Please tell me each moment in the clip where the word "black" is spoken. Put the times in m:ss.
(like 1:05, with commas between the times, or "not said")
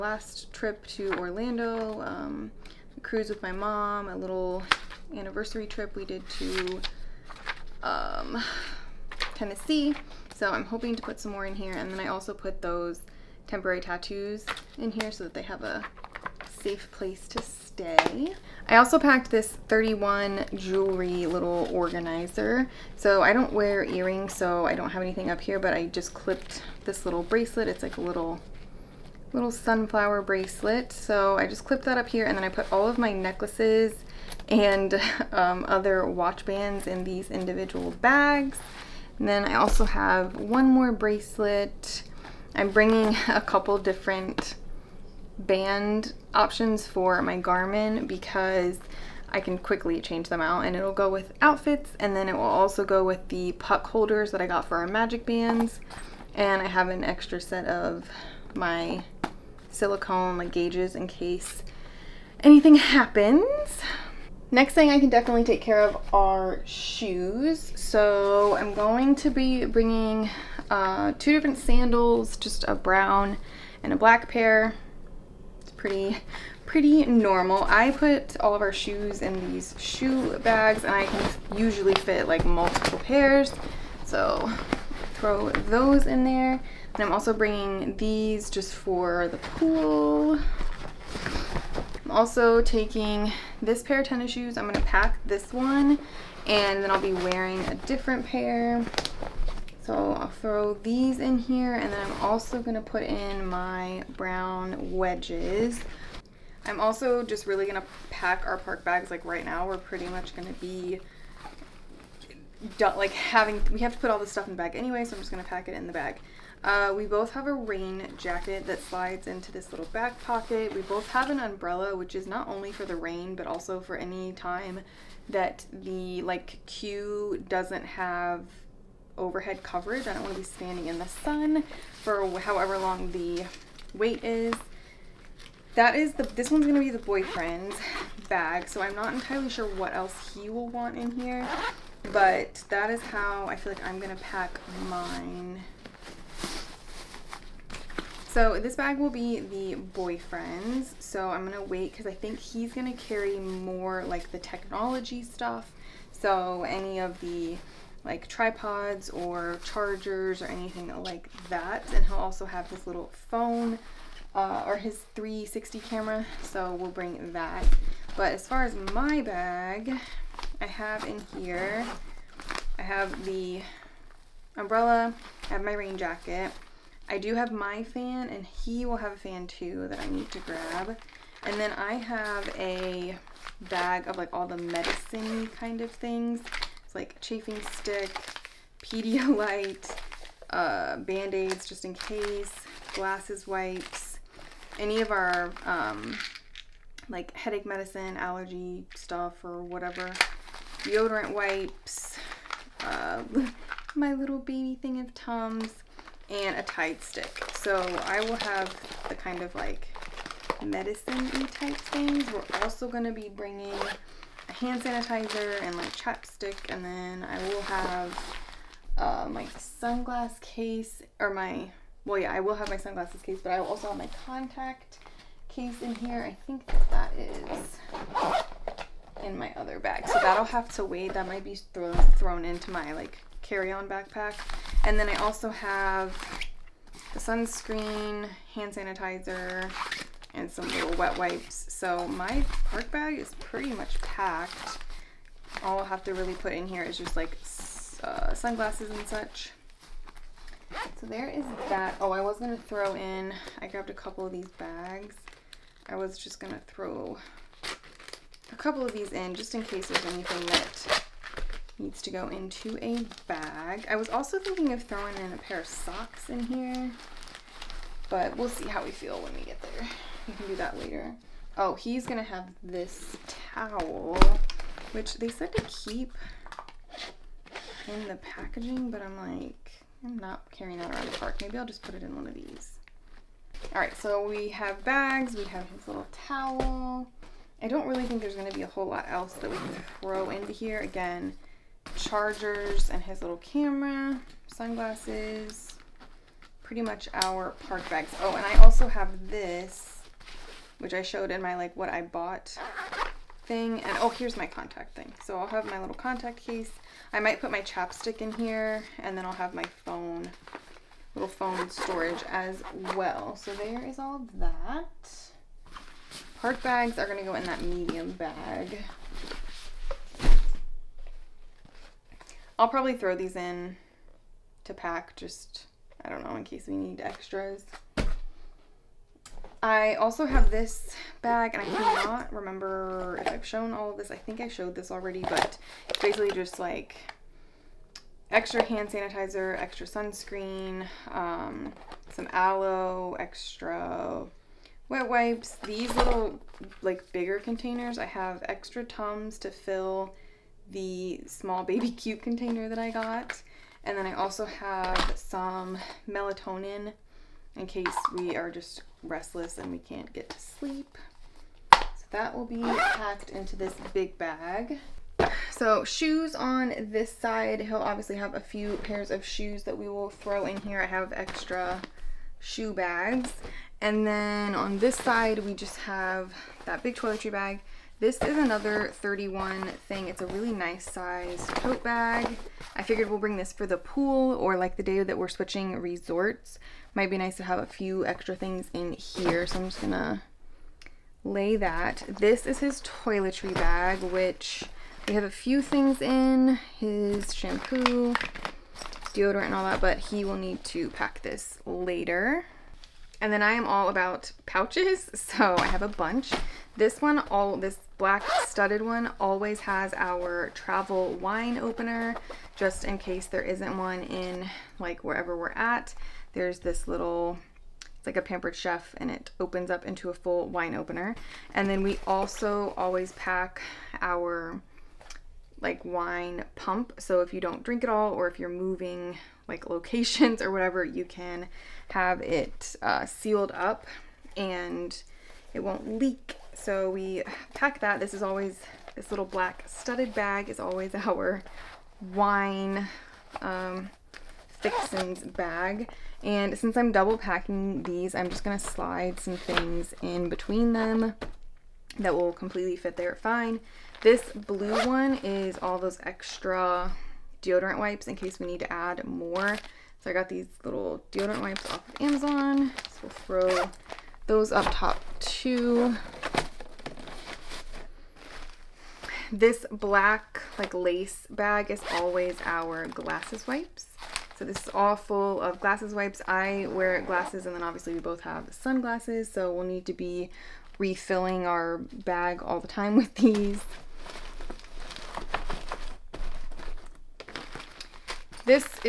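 1:13, 6:47, 7:19, 7:49.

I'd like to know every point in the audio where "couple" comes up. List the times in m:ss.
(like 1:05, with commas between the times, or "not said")
0:43, 4:13, 4:18.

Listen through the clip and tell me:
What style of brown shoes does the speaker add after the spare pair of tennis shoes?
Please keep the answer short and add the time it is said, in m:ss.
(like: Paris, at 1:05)
Wedges, at 1:44.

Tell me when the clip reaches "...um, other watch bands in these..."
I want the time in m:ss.
0:35.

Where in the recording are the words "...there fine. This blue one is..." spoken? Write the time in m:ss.
7:32.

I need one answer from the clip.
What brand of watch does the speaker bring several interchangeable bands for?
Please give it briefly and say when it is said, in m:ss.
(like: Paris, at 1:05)
Garmin, at 0:47.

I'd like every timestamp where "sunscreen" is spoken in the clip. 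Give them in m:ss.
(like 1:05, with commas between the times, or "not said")
3:57, 5:39.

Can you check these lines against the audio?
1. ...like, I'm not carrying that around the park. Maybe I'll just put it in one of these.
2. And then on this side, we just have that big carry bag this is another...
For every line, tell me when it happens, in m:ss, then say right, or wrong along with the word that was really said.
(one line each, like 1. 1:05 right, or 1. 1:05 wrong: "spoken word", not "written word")
1. 4:39 right
2. 6:13 wrong: "toiletry", not "carry".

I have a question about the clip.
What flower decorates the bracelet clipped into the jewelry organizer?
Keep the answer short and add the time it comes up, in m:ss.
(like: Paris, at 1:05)
Sunflower, at 0:29.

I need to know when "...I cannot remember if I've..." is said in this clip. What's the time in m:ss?
5:31.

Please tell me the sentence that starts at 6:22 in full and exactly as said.
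I figured we'll bring this for the pool or like the day that we're switching resorts.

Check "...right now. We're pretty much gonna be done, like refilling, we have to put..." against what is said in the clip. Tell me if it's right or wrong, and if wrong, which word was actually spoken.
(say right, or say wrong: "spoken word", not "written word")
wrong: "having", not "refilling".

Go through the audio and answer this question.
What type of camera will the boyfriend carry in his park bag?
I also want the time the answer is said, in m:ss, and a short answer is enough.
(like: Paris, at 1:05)
360 camera, at 2:45.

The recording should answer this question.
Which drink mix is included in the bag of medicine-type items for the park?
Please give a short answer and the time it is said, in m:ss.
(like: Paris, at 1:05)
Pedialyte, at 3:08.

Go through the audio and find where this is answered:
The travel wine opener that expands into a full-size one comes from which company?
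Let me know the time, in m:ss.
6:58.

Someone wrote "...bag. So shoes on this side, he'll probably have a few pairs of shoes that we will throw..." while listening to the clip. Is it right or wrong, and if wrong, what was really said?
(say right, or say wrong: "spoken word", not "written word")
wrong: "obviously", not "probably".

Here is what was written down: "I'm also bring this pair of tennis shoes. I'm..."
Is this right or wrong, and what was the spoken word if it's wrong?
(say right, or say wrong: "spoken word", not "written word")
wrong: "taking", not "bring".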